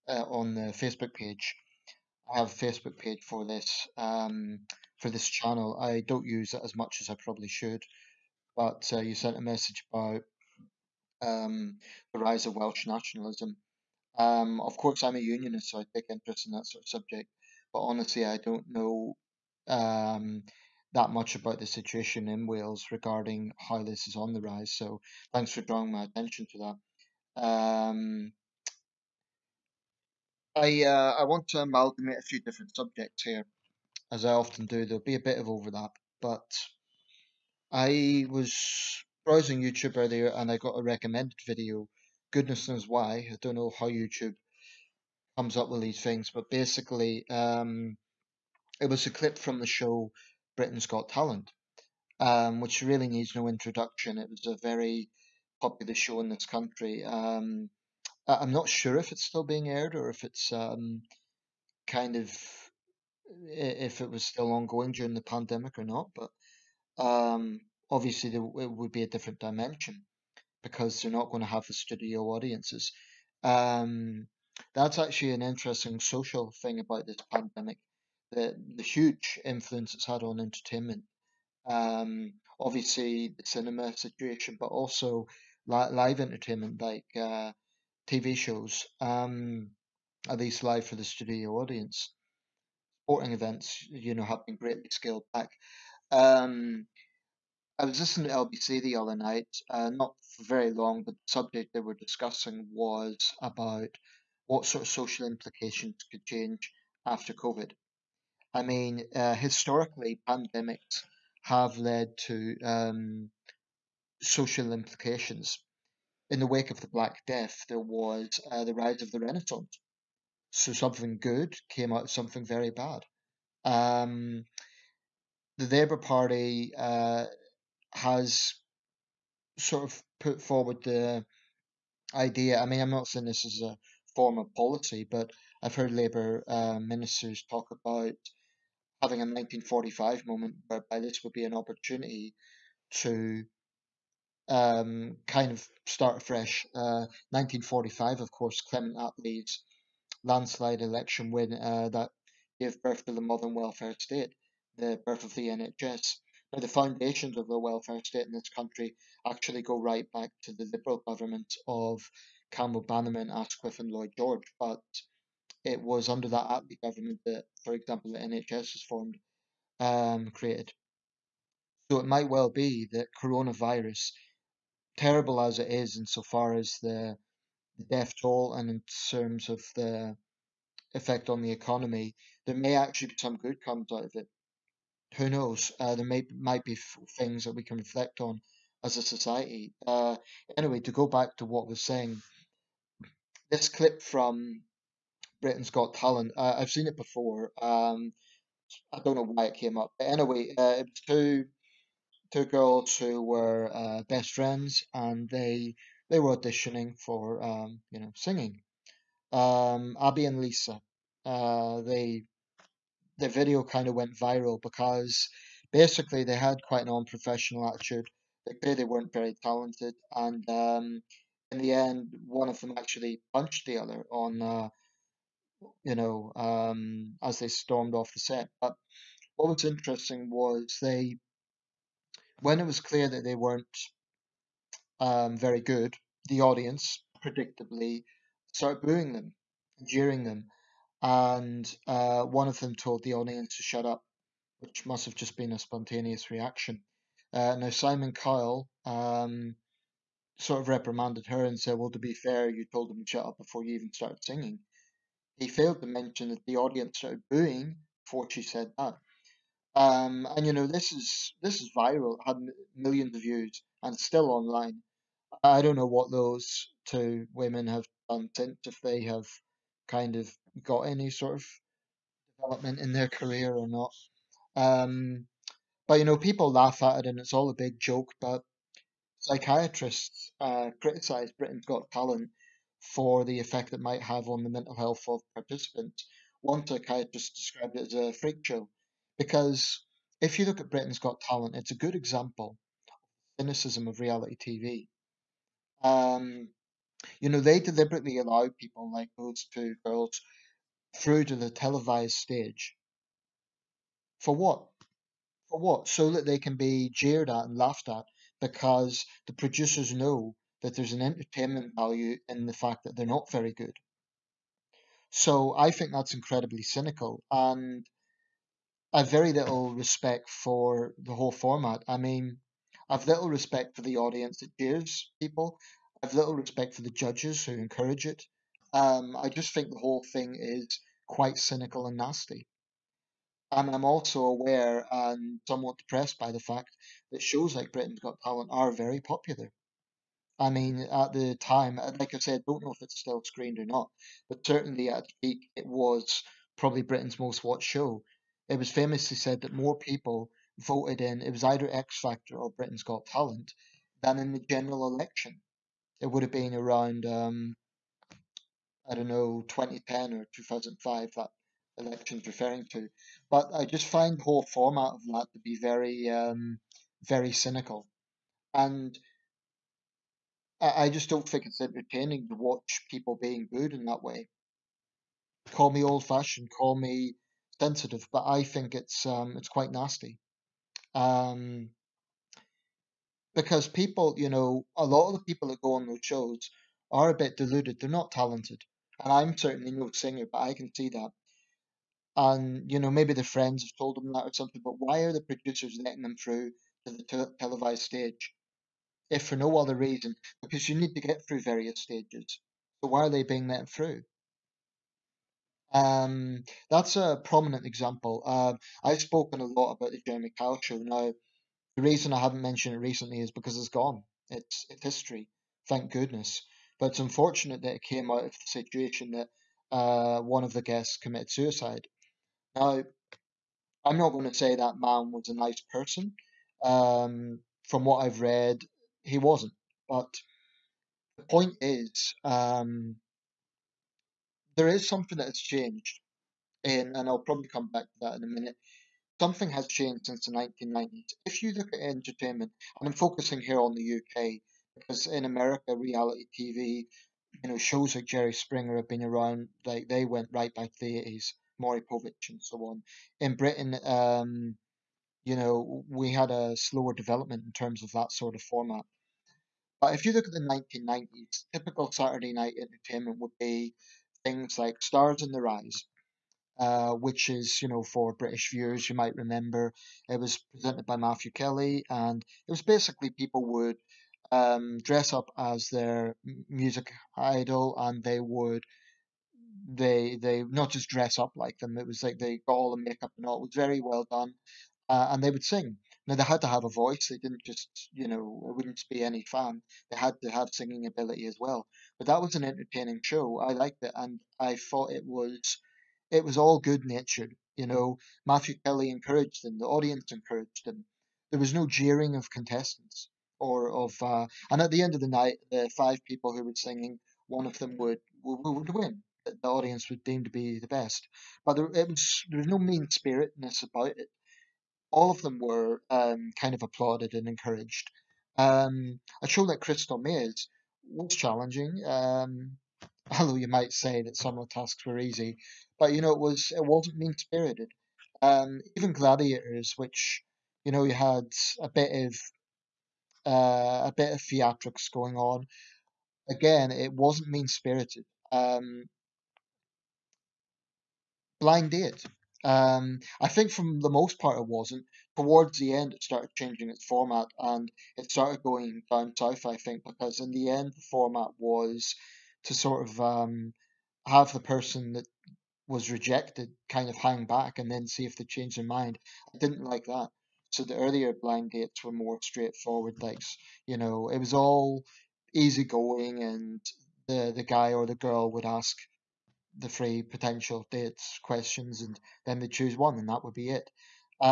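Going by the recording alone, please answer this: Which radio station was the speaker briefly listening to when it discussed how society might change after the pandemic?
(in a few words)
LBC.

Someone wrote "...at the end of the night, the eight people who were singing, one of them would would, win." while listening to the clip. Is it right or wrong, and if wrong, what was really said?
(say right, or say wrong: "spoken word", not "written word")
wrong: "five", not "eight".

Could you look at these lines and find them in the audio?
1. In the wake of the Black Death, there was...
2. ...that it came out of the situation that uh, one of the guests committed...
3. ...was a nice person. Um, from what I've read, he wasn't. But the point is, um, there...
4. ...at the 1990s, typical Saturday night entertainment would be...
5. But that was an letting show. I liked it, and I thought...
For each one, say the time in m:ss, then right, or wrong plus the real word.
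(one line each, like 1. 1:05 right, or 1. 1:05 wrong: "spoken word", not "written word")
1. 1:56 right
2. 6:57 right
3. 7:05 right
4. 7:40 right
5. 8:11 wrong: "entertaining", not "letting".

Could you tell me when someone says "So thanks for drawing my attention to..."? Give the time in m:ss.
0:24.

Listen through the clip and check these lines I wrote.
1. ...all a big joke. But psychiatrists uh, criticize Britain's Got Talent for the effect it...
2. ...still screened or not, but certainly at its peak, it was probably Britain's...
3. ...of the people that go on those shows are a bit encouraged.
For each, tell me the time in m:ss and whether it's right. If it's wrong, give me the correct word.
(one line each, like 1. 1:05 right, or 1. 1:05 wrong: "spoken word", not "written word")
1. 4:37 right
2. 5:42 right
3. 6:25 wrong: "deluded", not "encouraged".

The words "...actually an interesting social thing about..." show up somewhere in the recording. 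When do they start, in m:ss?
1:14.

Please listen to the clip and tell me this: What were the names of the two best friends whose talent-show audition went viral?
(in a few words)
Abby and Lisa.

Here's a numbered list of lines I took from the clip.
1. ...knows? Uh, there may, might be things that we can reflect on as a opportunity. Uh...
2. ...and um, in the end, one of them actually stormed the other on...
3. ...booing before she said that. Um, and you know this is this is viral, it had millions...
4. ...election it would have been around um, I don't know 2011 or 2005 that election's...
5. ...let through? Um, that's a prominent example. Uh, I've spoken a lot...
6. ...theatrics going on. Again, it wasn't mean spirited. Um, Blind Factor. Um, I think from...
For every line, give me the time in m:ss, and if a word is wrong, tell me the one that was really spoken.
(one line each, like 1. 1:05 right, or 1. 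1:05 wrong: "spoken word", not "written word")
1. 3:05 wrong: "society", not "opportunity"
2. 3:40 wrong: "punched", not "stormed"
3. 4:17 right
4. 5:54 wrong: "2010", not "2011"
5. 6:43 right
6. 8:54 wrong: "Date", not "Factor".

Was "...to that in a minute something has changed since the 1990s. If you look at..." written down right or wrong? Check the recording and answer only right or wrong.
right.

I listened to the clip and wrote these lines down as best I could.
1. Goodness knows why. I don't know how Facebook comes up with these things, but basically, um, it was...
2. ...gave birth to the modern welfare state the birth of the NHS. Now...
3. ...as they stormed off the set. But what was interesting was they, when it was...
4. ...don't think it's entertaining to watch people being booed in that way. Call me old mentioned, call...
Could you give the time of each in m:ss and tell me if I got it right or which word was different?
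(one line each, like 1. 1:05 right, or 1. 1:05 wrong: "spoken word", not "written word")
1. 0:42 wrong: "YouTube", not "Facebook"
2. 2:32 right
3. 3:47 right
4. 6:11 wrong: "fashioned", not "mentioned".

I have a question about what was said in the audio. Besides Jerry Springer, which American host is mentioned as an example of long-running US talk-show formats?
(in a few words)
Maury Povich.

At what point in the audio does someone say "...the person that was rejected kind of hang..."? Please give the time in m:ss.
9:14.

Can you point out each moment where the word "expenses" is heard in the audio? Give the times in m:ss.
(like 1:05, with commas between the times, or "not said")
not said.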